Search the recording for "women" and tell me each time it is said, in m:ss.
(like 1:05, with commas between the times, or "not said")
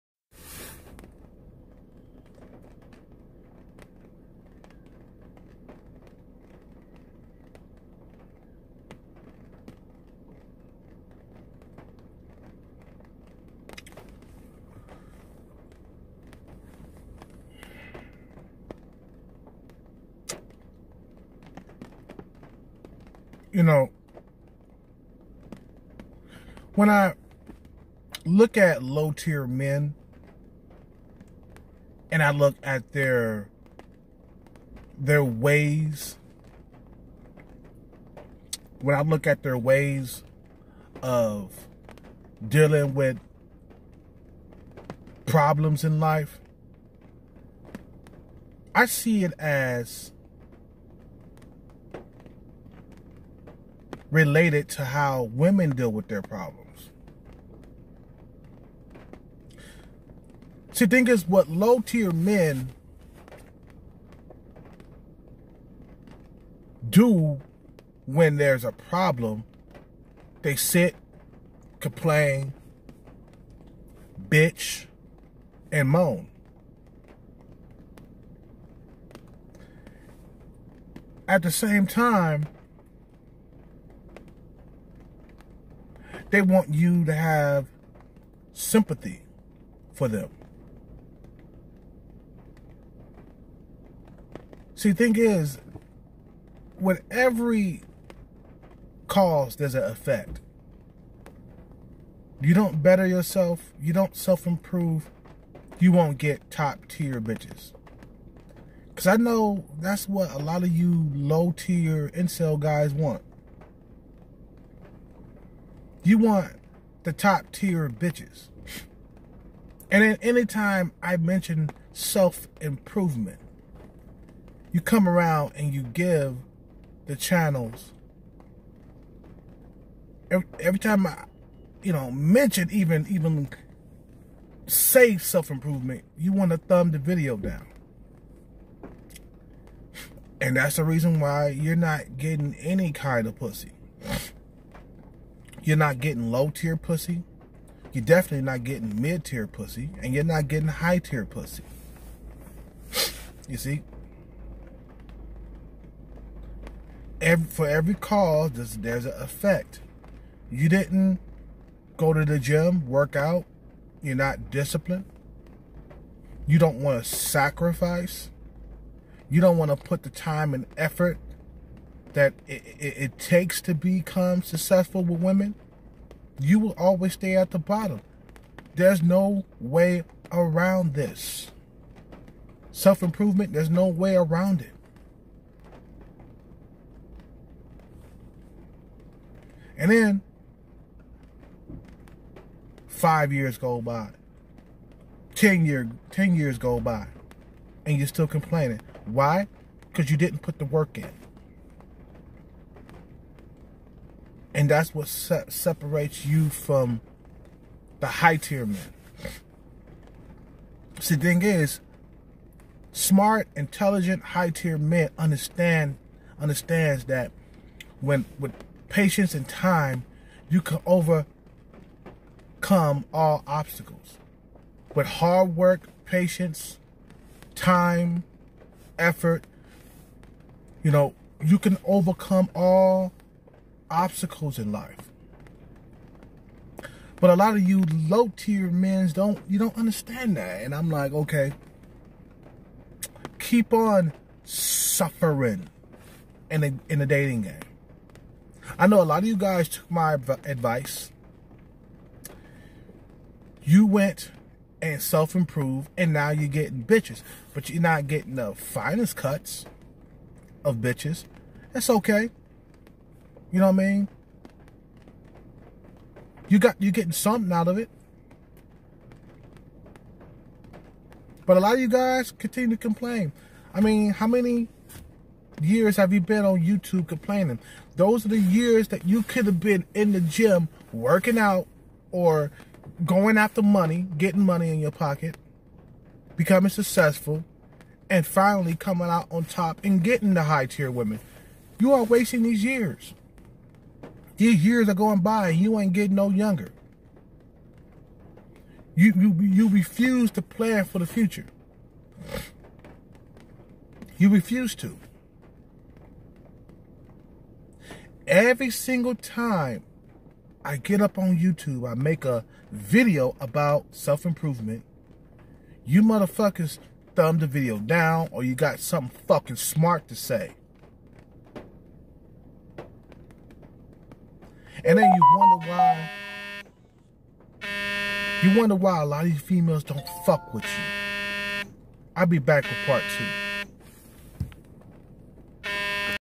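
0:55, 2:55, 4:50.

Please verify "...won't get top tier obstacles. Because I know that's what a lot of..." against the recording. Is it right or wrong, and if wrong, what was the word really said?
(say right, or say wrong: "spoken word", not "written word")
wrong: "bitches", not "obstacles".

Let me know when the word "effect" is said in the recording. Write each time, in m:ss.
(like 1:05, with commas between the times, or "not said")
1:39, 2:39.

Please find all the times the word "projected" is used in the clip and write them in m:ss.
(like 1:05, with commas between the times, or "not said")
not said.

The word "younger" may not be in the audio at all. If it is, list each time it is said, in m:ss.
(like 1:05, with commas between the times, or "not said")
4:56.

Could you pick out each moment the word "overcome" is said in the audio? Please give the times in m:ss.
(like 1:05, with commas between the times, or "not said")
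3:40, 3:51.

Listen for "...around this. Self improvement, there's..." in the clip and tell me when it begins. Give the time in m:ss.
3:00.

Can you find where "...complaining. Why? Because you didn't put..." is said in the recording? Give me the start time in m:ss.
3:18.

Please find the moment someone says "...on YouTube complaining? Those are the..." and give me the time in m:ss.
4:36.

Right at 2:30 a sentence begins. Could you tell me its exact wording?
And you're not getting high tier pussy.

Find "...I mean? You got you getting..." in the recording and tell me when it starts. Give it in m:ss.
4:23.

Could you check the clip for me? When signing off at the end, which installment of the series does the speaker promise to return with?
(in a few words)
part two.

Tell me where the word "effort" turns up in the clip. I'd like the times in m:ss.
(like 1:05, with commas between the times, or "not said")
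2:50, 3:48.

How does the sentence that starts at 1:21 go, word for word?
At the same time, They want you to have sympathy for them.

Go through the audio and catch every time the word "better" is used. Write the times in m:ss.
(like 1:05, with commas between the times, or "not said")
1:42.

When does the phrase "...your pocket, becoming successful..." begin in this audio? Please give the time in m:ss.
4:44.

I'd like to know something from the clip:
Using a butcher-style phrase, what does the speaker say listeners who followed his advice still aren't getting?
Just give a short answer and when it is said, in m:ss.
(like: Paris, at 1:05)
the finest cuts, at 4:18.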